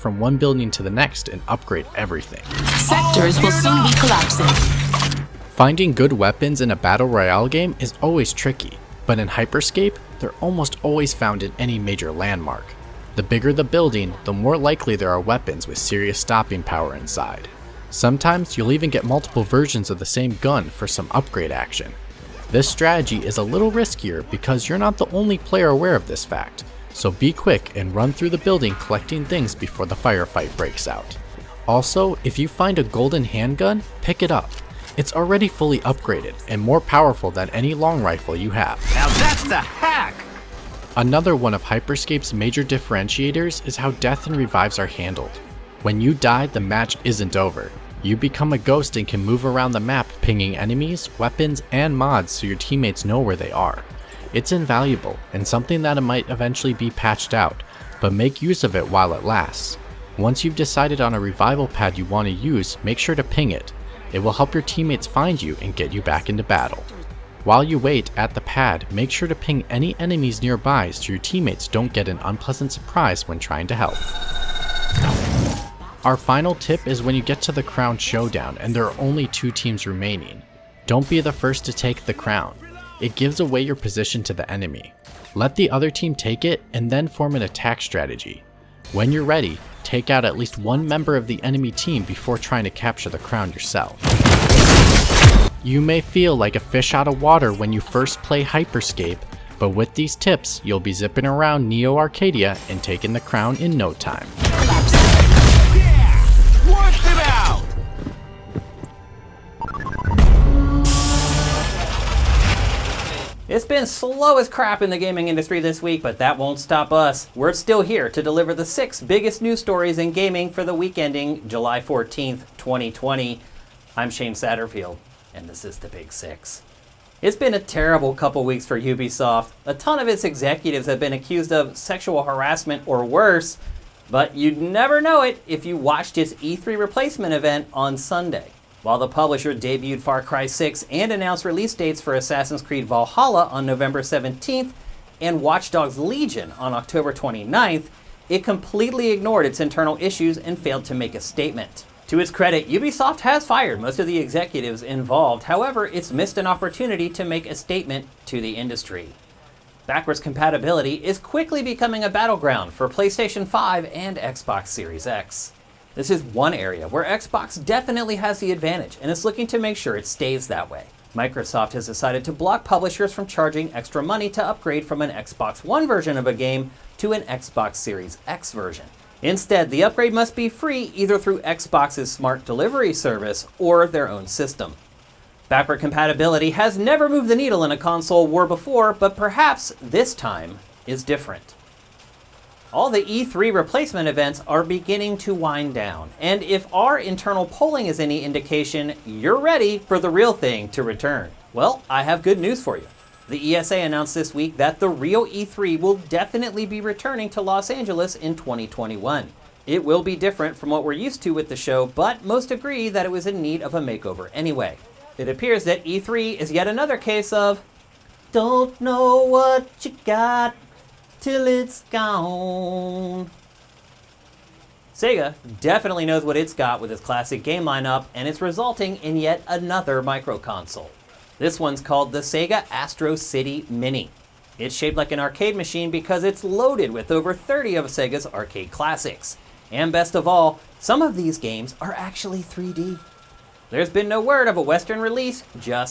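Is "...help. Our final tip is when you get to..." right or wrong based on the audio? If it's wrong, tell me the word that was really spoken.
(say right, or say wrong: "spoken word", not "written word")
right.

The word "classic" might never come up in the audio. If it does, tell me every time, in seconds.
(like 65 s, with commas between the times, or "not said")
226 s, 238 s.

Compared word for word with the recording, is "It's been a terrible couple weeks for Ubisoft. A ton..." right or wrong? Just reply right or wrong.
right.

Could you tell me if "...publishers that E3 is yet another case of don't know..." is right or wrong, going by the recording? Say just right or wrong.
wrong.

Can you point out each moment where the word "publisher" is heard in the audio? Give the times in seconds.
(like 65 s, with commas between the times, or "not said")
139 s, 172 s.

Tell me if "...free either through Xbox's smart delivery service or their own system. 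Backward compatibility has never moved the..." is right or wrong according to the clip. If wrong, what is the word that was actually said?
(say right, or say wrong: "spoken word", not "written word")
right.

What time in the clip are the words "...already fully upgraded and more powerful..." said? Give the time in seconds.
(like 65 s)
35 s.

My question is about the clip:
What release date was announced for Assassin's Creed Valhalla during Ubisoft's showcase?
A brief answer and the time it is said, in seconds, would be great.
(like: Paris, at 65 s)
November 17th, at 143 s.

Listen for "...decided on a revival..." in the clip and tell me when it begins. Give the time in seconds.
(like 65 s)
60 s.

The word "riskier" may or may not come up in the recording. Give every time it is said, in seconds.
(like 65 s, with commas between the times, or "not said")
23 s.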